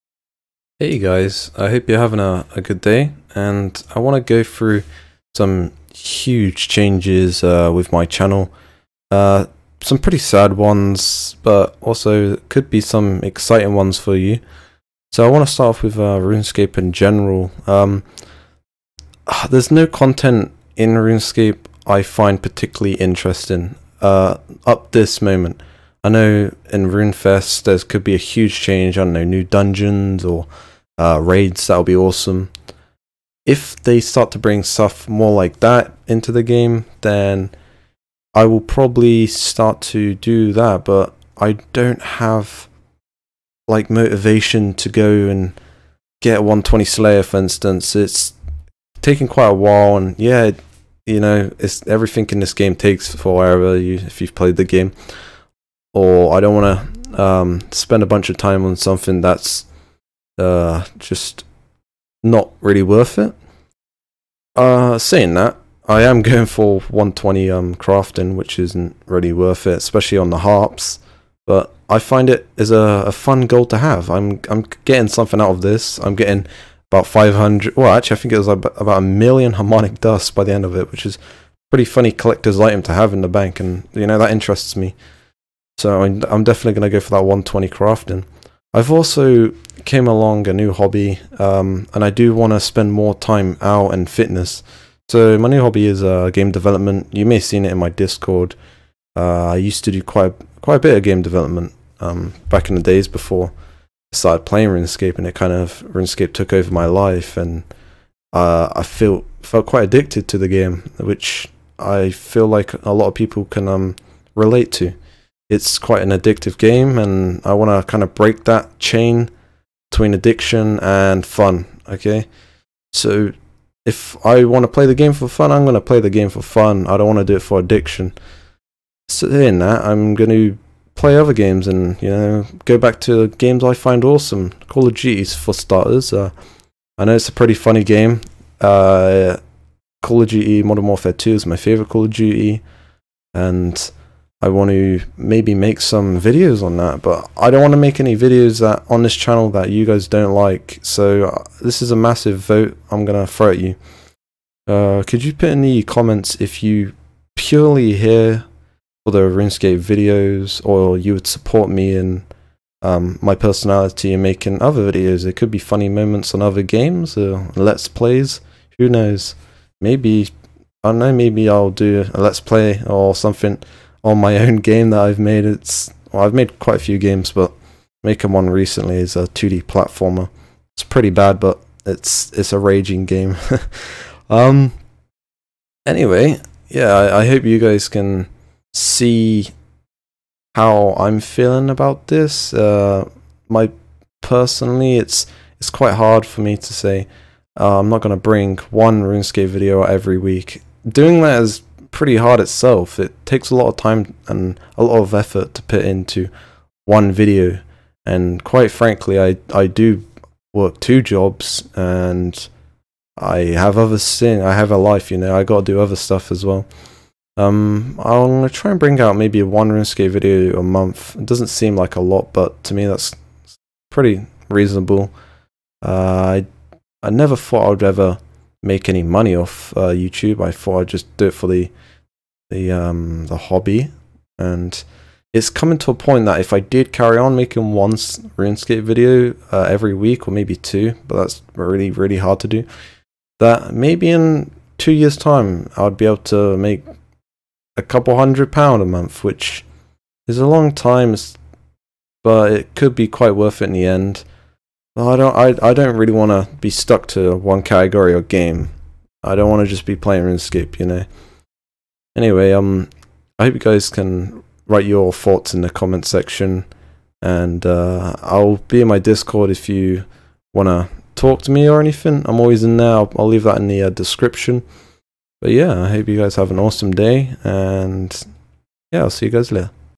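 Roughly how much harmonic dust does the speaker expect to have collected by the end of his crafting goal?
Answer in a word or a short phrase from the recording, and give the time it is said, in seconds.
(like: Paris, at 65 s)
1 million, at 78 s.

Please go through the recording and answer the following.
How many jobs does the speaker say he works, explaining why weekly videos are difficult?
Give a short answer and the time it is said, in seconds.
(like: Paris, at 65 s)
2, at 210 s.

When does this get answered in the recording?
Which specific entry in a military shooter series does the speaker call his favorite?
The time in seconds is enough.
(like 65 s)
140 s.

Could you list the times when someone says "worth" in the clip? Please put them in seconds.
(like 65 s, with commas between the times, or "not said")
62 s, 69 s, 253 s.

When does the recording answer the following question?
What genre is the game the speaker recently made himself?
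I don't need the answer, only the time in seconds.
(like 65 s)
179 s.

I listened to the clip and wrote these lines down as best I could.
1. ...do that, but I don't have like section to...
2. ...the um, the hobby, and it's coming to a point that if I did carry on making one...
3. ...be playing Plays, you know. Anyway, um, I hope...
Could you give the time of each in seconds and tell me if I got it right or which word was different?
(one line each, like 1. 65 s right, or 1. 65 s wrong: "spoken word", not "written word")
1. 40 s wrong: "motivation", not "section"
2. 232 s right
3. 259 s wrong: "RuneScape", not "Plays".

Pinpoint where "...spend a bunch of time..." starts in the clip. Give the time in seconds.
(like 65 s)
57 s.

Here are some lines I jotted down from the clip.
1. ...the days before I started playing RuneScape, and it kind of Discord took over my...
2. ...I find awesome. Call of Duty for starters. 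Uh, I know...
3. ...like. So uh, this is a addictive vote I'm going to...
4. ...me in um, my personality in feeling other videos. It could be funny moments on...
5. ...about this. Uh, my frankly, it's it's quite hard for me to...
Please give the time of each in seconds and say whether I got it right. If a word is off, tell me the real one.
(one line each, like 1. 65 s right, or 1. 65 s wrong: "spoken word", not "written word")
1. 102 s wrong: "RuneScape", not "Discord"
2. 133 s right
3. 150 s wrong: "massive", not "addictive"
4. 161 s wrong: "making", not "feeling"
5. 191 s wrong: "personally", not "frankly".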